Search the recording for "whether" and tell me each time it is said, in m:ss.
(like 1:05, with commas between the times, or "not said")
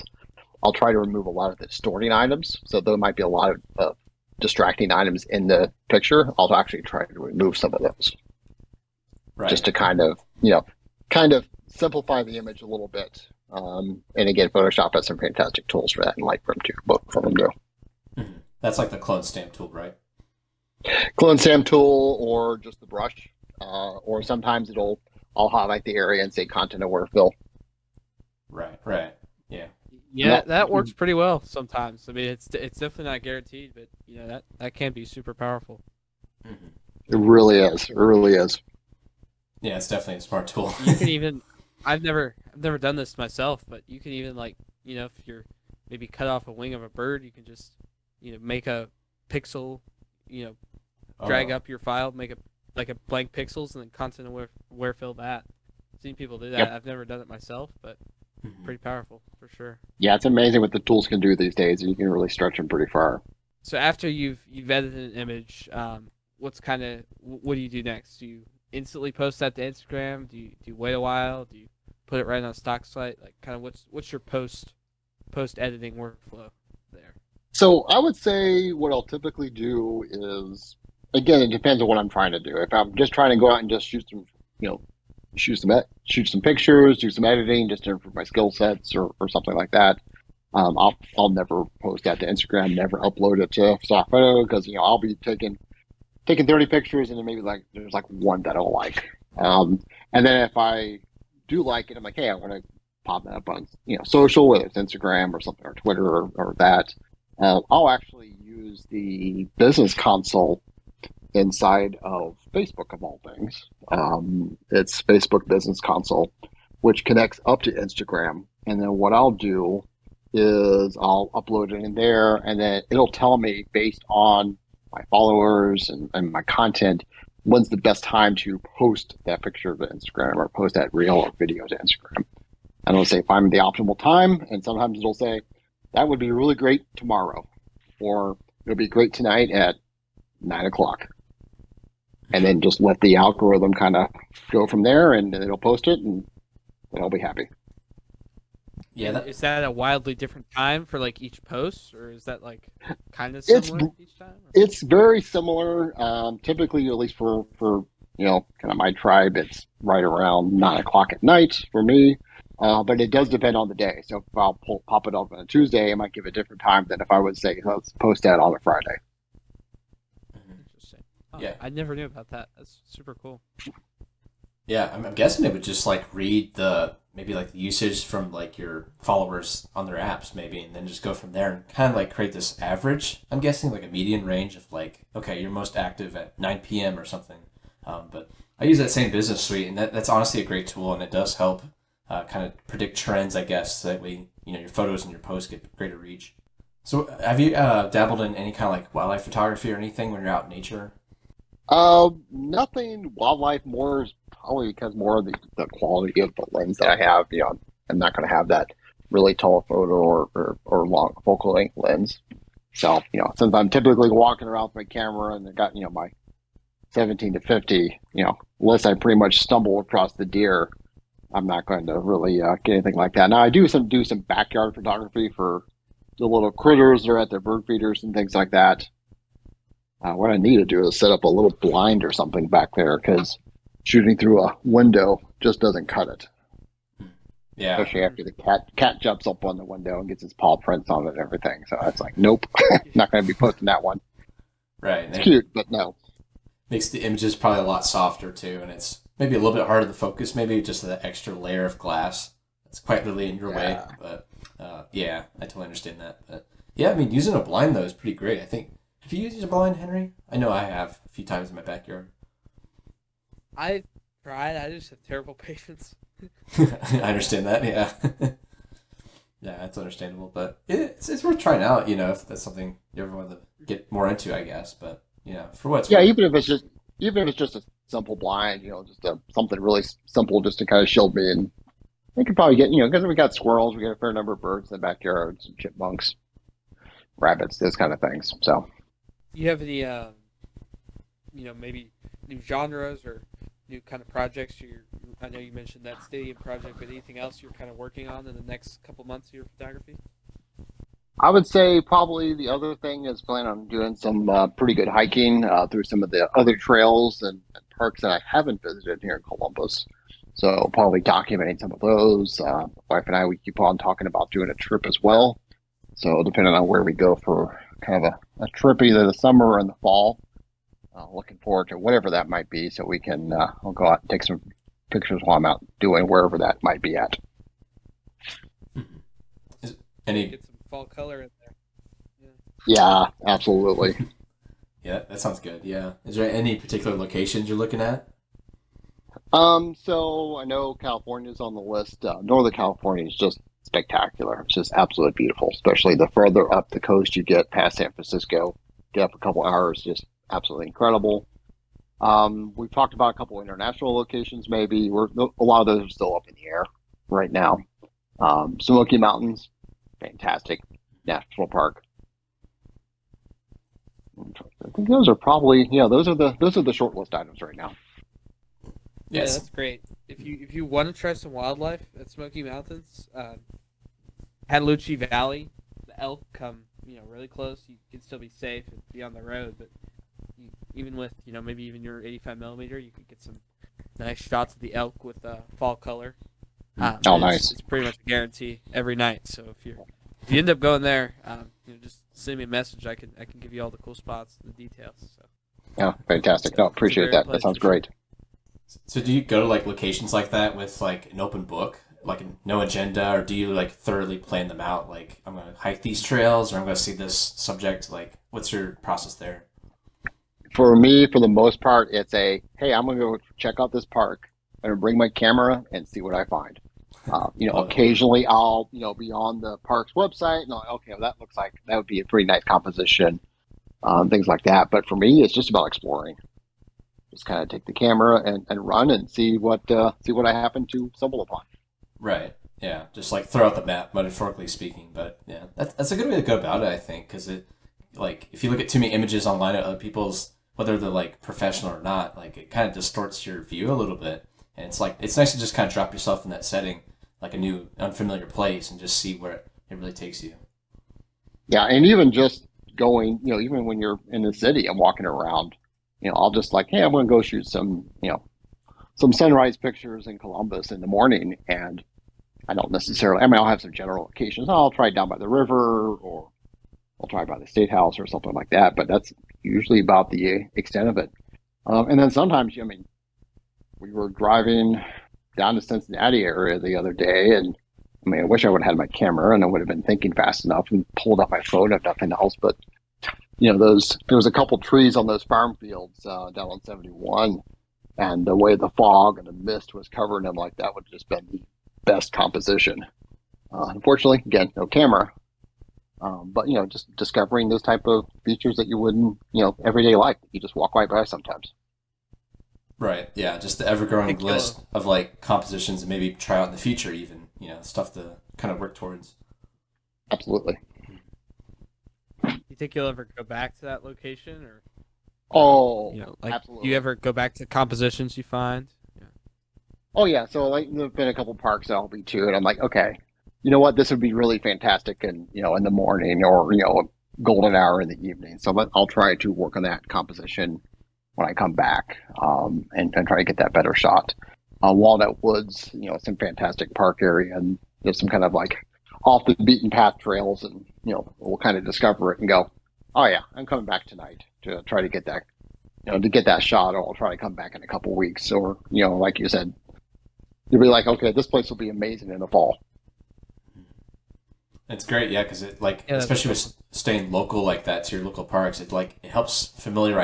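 1:44, 7:20.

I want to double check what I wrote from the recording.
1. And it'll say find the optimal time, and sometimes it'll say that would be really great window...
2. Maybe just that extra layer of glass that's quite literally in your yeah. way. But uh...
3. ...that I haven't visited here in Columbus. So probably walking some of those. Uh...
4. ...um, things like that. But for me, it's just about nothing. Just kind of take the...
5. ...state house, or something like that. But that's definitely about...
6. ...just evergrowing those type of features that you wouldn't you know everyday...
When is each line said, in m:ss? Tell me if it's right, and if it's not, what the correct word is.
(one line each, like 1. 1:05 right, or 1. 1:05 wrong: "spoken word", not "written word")
1. 2:12 wrong: "tomorrow", not "window"
2. 4:10 right
3. 5:08 wrong: "documenting", not "walking"
4. 7:03 wrong: "exploring", not "nothing"
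5. 7:47 wrong: "usually", not "definitely"
6. 8:16 wrong: "discovering", not "evergrowing".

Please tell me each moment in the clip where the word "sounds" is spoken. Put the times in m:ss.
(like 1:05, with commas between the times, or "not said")
5:35, 6:37.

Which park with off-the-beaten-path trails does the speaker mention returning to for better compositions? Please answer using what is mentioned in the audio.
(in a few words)
Walnut Woods.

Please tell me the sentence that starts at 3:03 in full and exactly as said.
I'm guessing like a median range of like okay, you're most active at 9 p.m.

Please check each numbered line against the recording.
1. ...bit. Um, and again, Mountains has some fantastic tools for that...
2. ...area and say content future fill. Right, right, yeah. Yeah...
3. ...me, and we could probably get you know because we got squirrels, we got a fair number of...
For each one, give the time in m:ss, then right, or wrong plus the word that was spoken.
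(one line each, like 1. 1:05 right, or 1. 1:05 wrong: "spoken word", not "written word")
1. 0:12 wrong: "Photoshop", not "Mountains"
2. 0:25 wrong: "aware", not "future"
3. 4:41 right.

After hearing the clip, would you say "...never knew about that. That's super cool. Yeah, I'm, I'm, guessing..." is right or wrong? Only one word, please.
right.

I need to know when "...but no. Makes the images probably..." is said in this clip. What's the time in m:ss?
4:05.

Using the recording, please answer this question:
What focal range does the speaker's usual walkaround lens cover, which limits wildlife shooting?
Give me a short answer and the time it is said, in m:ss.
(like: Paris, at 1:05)
17 to 50, at 3:36.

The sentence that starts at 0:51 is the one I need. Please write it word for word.
up your file, make a like a blank pixels and then content aware where fill that.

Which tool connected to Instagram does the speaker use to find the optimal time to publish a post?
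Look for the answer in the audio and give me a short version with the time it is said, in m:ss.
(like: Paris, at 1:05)
Facebook Business Console, at 1:55.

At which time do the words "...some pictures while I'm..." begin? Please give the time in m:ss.
5:24.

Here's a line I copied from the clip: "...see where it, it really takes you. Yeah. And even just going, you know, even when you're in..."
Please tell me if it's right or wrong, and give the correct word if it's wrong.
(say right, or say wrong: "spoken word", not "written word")
right.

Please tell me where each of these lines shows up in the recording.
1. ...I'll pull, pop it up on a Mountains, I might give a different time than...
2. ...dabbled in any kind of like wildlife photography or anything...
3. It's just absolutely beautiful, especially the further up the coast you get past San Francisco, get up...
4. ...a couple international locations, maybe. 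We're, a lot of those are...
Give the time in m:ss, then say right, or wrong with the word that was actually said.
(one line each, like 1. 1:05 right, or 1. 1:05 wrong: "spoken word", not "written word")
1. 2:44 wrong: "Tuesday", not "Mountains"
2. 3:17 right
3. 5:44 right
4. 5:53 right.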